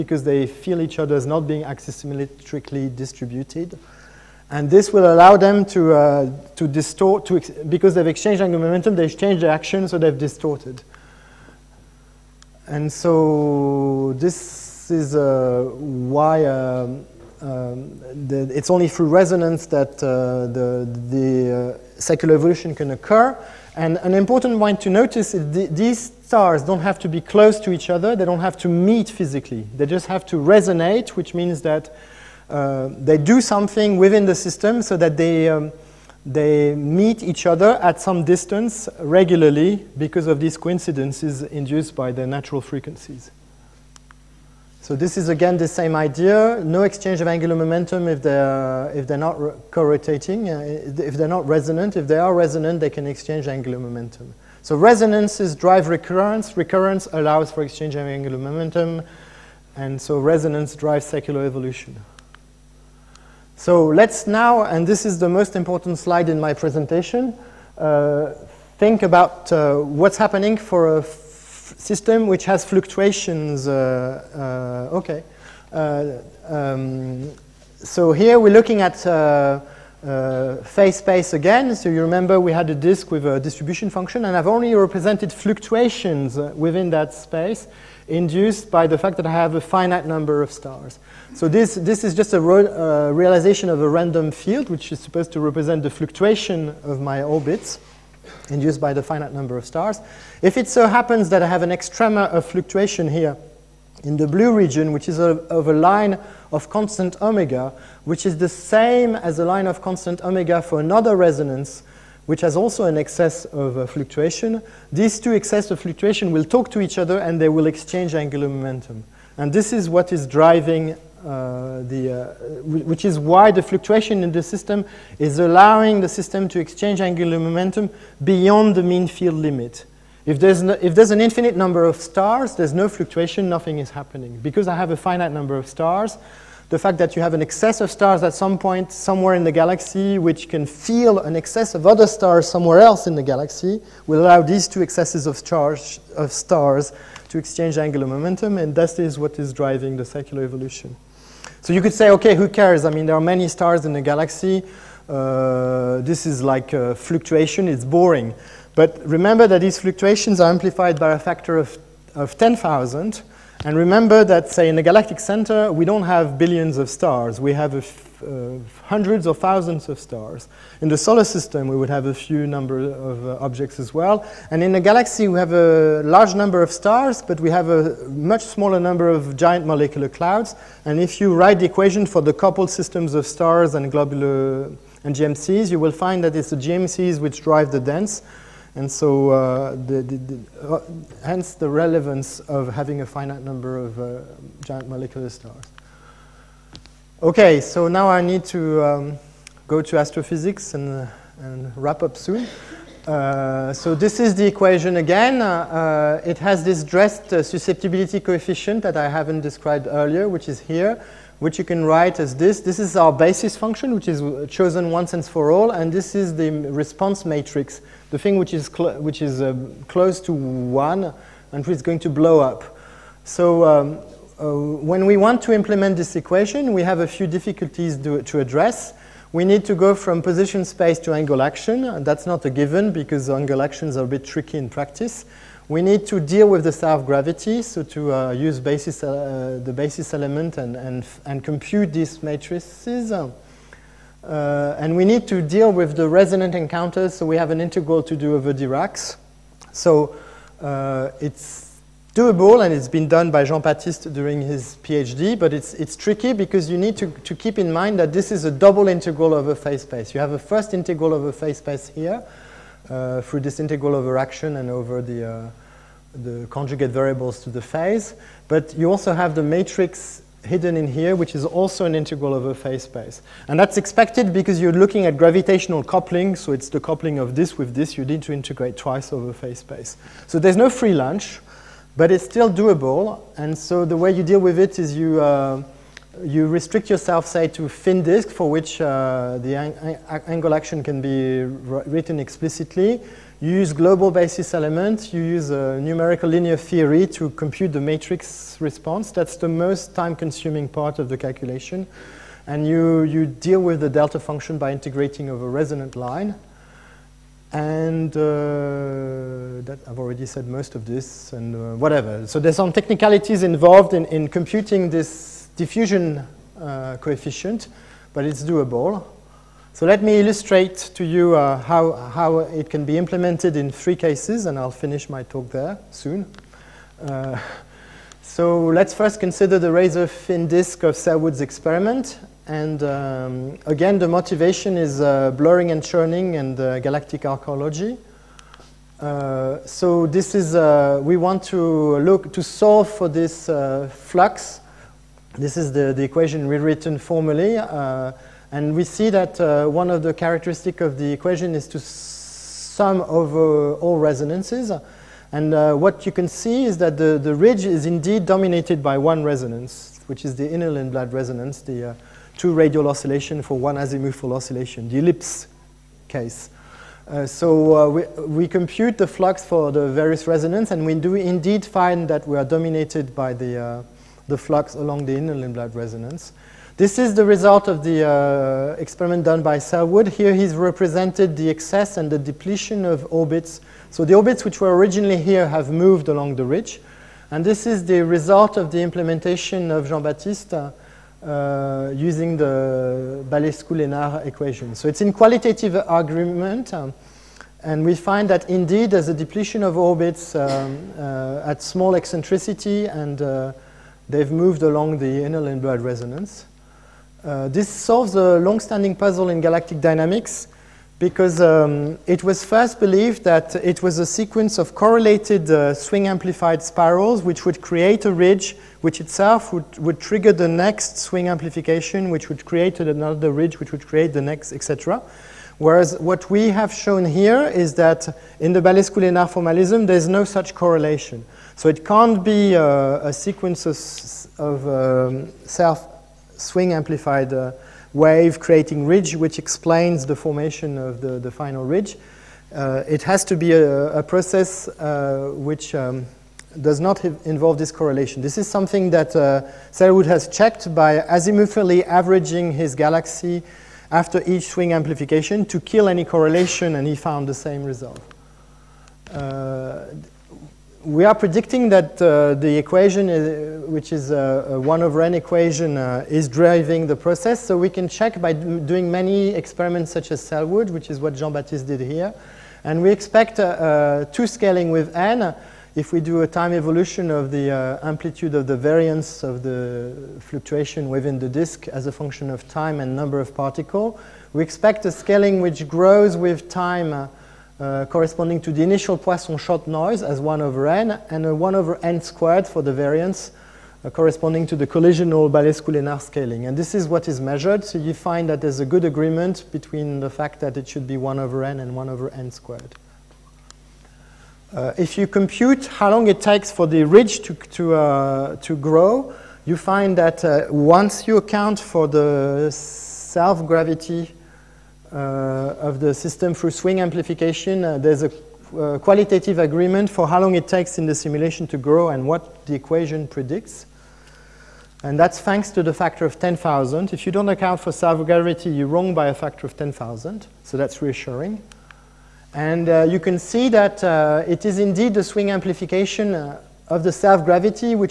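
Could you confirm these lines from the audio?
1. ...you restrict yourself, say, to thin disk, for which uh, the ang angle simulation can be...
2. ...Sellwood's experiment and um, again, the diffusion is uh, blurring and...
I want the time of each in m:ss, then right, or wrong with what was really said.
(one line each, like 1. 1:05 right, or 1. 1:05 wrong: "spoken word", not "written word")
1. 4:46 wrong: "action", not "simulation"
2. 5:30 wrong: "motivation", not "diffusion".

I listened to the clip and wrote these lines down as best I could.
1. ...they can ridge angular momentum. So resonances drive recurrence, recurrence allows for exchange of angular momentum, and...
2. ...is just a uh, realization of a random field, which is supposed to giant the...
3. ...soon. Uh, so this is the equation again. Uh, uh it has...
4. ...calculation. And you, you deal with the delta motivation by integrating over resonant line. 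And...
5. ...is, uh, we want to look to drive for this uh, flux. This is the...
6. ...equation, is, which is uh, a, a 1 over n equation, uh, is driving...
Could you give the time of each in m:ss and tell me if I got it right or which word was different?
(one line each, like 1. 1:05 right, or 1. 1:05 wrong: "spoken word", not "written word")
1. 0:52 wrong: "exchange", not "ridge"
2. 1:32 wrong: "represent", not "giant"
3. 3:22 right
4. 5:01 wrong: "function", not "motivation"
5. 5:40 wrong: "solve", not "drive"
6. 7:42 right.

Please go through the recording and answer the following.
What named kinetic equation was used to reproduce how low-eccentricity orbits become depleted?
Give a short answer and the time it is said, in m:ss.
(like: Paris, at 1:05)
Balescu-Lenard equation, at 6:33.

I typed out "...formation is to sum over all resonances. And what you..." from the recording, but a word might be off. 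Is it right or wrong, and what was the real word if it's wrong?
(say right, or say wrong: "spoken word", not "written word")
wrong: "equation", not "formation".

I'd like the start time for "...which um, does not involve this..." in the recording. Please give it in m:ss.
7:25.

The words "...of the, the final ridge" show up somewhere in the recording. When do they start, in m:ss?
7:20.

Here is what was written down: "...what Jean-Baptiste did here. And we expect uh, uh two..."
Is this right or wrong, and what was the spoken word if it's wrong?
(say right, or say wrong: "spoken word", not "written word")
right.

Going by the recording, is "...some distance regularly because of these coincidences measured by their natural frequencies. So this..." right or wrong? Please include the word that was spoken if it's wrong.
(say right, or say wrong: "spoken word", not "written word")
wrong: "induced", not "measured".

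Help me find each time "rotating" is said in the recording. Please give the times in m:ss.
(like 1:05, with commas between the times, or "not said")
0:49.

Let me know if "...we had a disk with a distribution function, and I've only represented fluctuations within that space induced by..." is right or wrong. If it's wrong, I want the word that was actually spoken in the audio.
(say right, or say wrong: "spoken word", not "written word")
right.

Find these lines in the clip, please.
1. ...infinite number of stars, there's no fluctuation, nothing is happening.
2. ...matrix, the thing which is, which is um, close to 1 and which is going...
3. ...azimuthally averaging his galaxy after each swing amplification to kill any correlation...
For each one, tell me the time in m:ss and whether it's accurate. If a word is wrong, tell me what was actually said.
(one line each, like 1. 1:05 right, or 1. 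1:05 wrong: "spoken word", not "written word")
1. 2:11 right
2. 3:37 right
3. 7:31 right.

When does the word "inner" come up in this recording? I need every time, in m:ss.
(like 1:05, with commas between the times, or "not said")
6:00, 6:15, 6:45.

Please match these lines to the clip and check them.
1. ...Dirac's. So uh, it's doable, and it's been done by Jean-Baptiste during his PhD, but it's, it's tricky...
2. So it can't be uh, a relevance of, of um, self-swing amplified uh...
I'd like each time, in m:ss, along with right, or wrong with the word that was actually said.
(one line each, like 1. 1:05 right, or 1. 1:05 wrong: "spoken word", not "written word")
1. 4:08 right
2. 7:11 wrong: "sequence", not "relevance".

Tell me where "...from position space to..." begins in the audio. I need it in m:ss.
3:49.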